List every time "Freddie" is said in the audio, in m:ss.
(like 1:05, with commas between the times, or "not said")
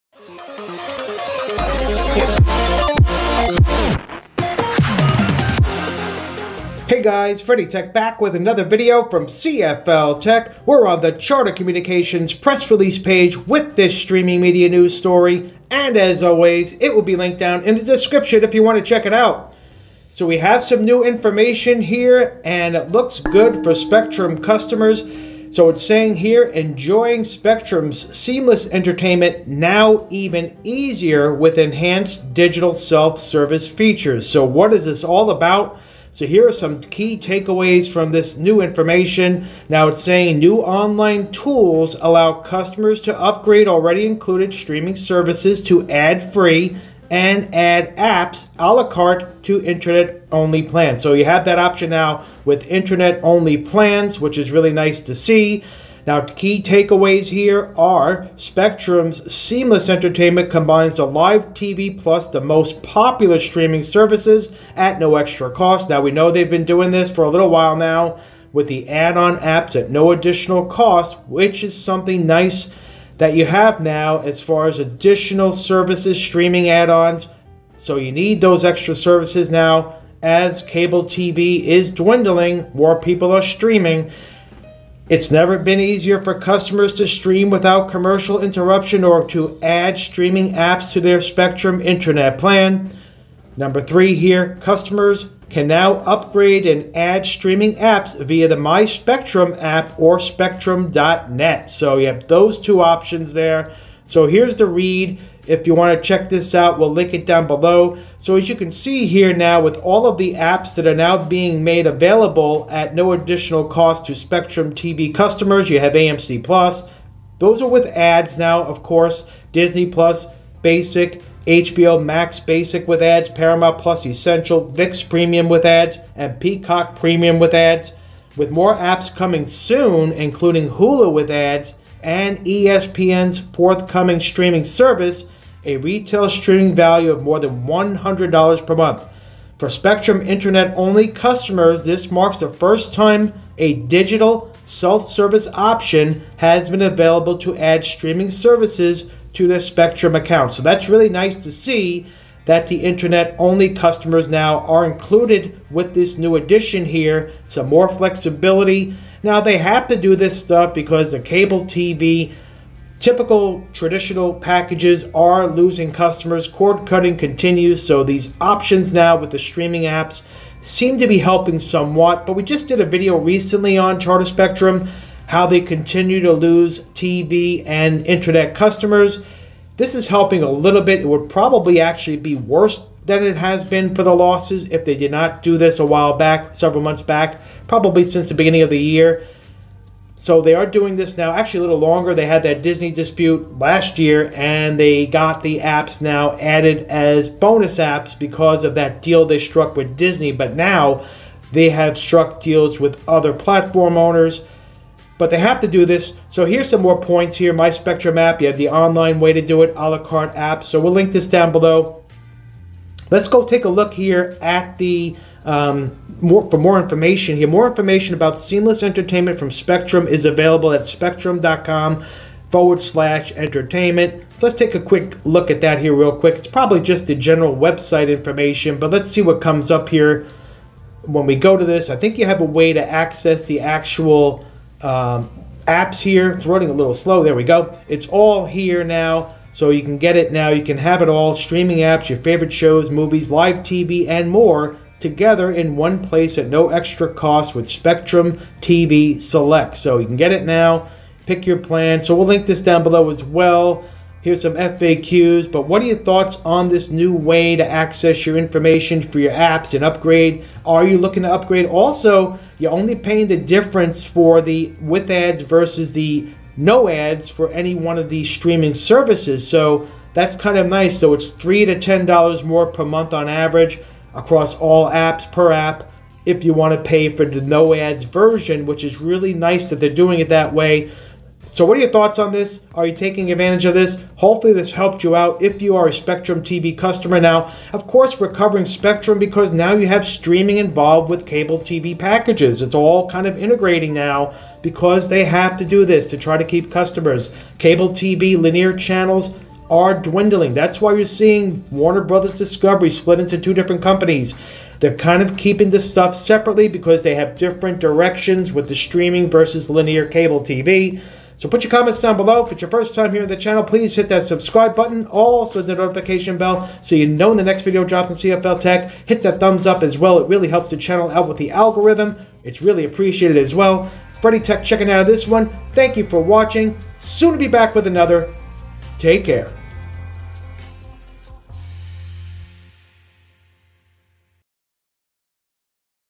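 0:07, 5:24.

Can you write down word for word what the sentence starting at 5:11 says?
So put your comments down below.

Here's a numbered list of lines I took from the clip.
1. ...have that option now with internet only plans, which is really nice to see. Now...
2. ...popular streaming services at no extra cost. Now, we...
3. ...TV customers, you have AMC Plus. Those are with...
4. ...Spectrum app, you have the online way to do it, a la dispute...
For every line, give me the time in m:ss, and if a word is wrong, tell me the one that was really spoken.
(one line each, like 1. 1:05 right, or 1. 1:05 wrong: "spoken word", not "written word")
1. 0:51 right
2. 1:02 right
3. 1:54 right
4. 3:27 wrong: "carte", not "dispute".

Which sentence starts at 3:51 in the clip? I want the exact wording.
I think you have a way to access the actual um, apps here.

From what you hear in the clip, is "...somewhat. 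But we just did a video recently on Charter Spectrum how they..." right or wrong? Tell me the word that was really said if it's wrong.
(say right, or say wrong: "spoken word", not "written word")
right.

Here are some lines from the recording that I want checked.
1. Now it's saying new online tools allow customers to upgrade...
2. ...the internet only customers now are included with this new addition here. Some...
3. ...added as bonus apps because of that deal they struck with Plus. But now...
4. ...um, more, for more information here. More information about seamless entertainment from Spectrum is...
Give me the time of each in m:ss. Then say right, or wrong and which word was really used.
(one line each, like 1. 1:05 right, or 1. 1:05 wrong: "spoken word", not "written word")
1. 0:39 right
2. 2:32 right
3. 3:16 wrong: "Disney", not "Plus"
4. 3:35 right.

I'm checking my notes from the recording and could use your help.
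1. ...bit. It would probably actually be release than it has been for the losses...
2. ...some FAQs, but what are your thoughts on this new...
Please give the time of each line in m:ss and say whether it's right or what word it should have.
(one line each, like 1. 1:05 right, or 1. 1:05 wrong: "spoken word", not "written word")
1. 3:00 wrong: "worse", not "release"
2. 4:14 right.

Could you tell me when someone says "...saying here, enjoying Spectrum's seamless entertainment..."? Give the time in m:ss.
0:25.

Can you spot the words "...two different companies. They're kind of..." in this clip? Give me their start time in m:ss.
5:03.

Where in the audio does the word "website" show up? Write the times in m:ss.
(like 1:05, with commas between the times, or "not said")
3:47.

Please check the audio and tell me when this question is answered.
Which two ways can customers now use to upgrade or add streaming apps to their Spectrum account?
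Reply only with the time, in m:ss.
1:38.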